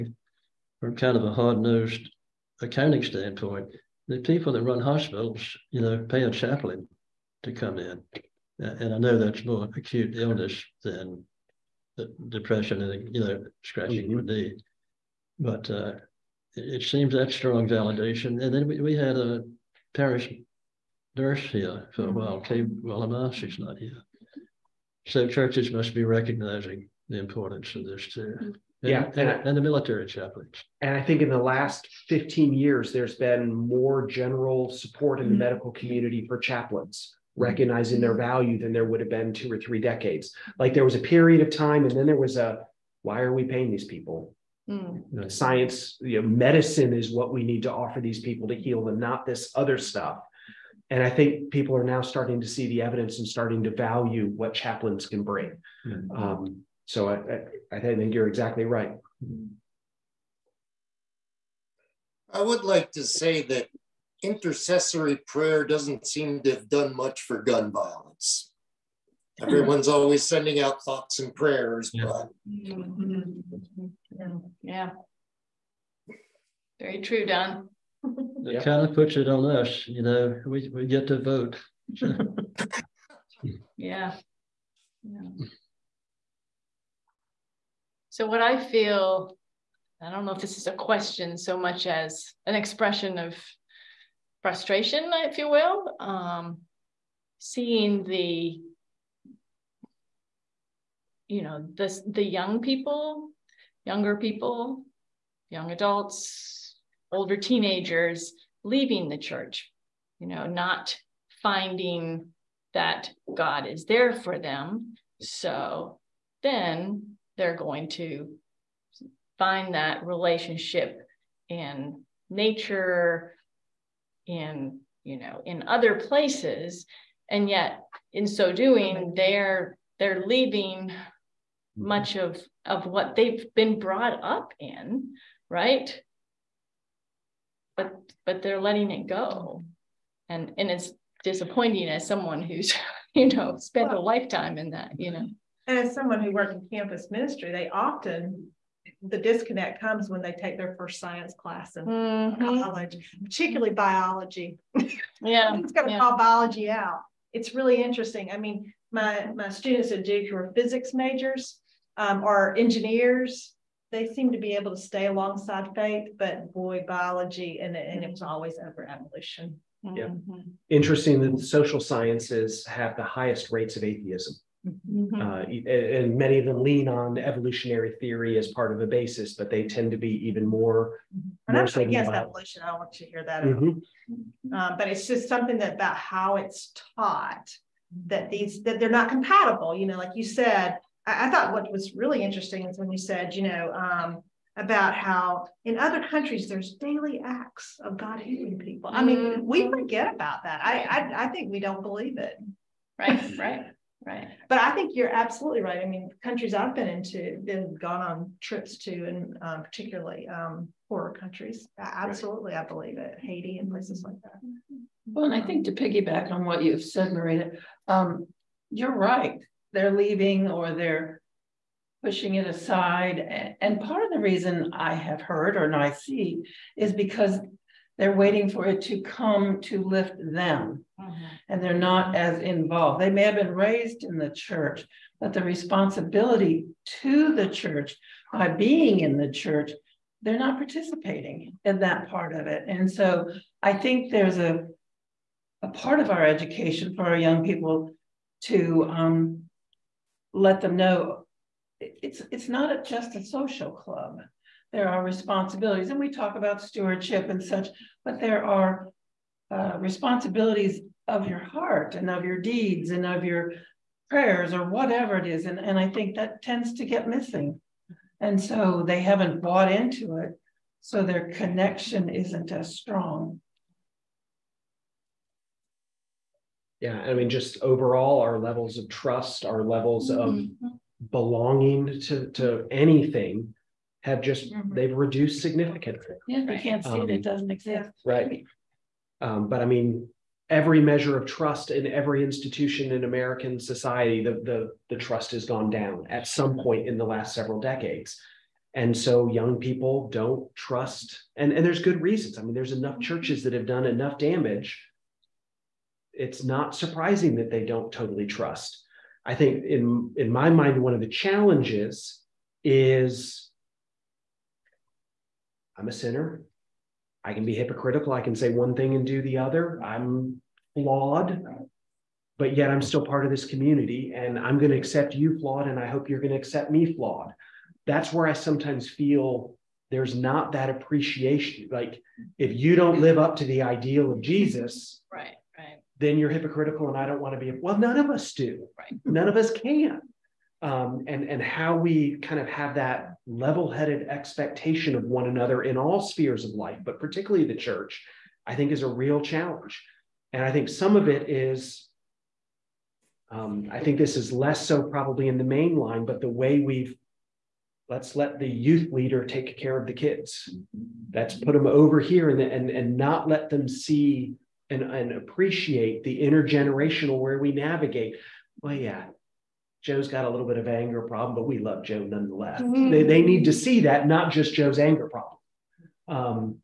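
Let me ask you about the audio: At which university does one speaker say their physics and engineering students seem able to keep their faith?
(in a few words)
Duke.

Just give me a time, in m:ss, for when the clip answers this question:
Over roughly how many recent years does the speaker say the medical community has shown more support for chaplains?
0:32.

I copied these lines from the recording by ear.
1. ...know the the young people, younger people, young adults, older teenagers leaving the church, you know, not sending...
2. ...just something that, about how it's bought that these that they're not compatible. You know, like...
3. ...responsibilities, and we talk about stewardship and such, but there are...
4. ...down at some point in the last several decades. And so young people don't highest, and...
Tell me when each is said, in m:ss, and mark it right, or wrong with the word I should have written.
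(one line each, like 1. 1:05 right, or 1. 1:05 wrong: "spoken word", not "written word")
1. 1:41 wrong: "finding", not "sending"
2. 3:05 wrong: "taught", not "bought"
3. 4:15 right
4. 4:55 wrong: "trust", not "highest".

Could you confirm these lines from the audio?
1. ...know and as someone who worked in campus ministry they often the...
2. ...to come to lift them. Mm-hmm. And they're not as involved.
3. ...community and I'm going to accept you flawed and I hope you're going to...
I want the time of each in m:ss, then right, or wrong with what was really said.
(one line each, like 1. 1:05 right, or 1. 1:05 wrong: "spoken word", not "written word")
1. 2:25 right
2. 3:48 right
3. 5:23 right.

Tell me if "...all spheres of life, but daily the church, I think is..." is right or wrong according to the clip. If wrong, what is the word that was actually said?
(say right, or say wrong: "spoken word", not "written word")
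wrong: "particularly", not "daily".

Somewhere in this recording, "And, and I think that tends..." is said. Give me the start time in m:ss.
4:25.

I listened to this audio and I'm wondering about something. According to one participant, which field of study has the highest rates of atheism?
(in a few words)
social sciences.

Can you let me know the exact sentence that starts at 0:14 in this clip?
your knee, but uh, it, it, seems that strong validation.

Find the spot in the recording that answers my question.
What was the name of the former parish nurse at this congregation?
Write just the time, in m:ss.
0:22.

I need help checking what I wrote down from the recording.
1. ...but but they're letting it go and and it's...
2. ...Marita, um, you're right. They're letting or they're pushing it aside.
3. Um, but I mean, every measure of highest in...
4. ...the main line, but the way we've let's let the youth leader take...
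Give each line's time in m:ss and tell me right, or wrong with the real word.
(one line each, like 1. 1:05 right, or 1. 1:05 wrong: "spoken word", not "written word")
1. 2:17 right
2. 3:37 wrong: "leaving", not "letting"
3. 4:49 wrong: "trust", not "highest"
4. 5:55 right.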